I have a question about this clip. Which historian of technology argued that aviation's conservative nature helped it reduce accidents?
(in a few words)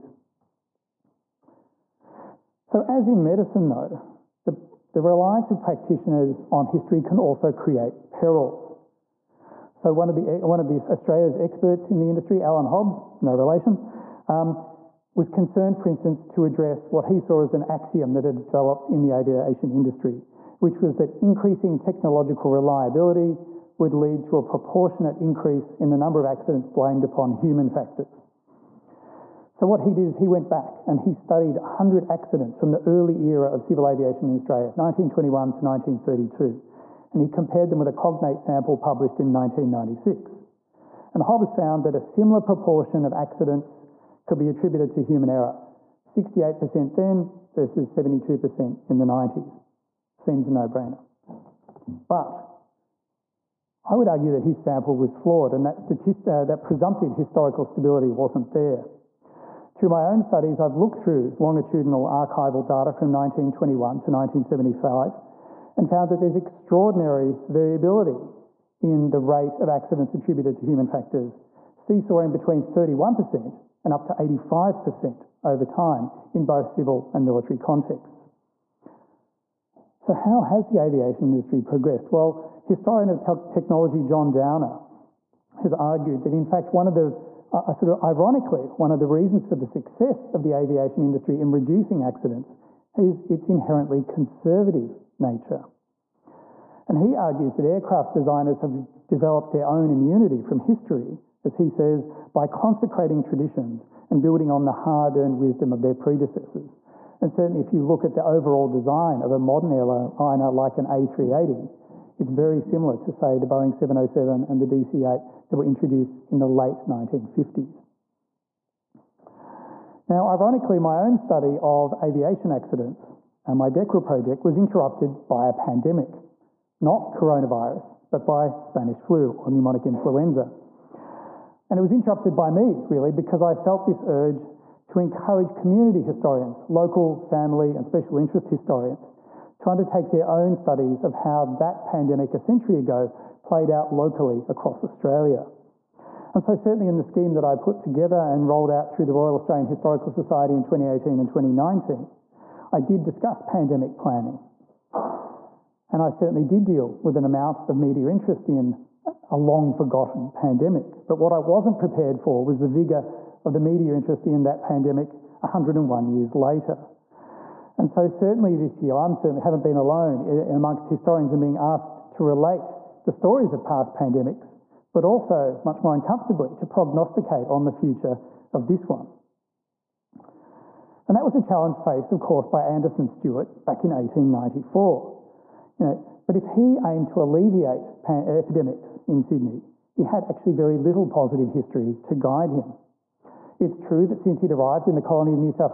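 John Downer.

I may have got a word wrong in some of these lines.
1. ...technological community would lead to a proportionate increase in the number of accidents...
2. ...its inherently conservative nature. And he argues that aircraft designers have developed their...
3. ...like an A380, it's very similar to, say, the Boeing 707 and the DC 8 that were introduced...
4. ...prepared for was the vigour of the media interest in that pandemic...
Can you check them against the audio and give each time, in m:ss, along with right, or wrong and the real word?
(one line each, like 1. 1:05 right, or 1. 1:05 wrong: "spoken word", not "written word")
1. 0:21 wrong: "reliability", not "community"
2. 1:33 right
3. 1:50 right
4. 2:41 right.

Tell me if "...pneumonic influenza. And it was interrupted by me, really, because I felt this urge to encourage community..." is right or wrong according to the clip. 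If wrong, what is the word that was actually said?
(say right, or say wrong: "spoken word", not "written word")
right.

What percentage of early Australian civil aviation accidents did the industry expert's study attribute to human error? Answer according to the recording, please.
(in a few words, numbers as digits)
68%.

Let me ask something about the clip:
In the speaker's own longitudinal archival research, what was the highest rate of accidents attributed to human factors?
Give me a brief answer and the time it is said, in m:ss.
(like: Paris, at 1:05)
85%, at 1:14.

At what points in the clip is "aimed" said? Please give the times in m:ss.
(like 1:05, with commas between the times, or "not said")
3:06.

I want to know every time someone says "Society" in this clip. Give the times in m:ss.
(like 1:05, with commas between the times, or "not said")
2:30.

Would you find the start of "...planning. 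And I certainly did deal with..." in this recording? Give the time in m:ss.
2:33.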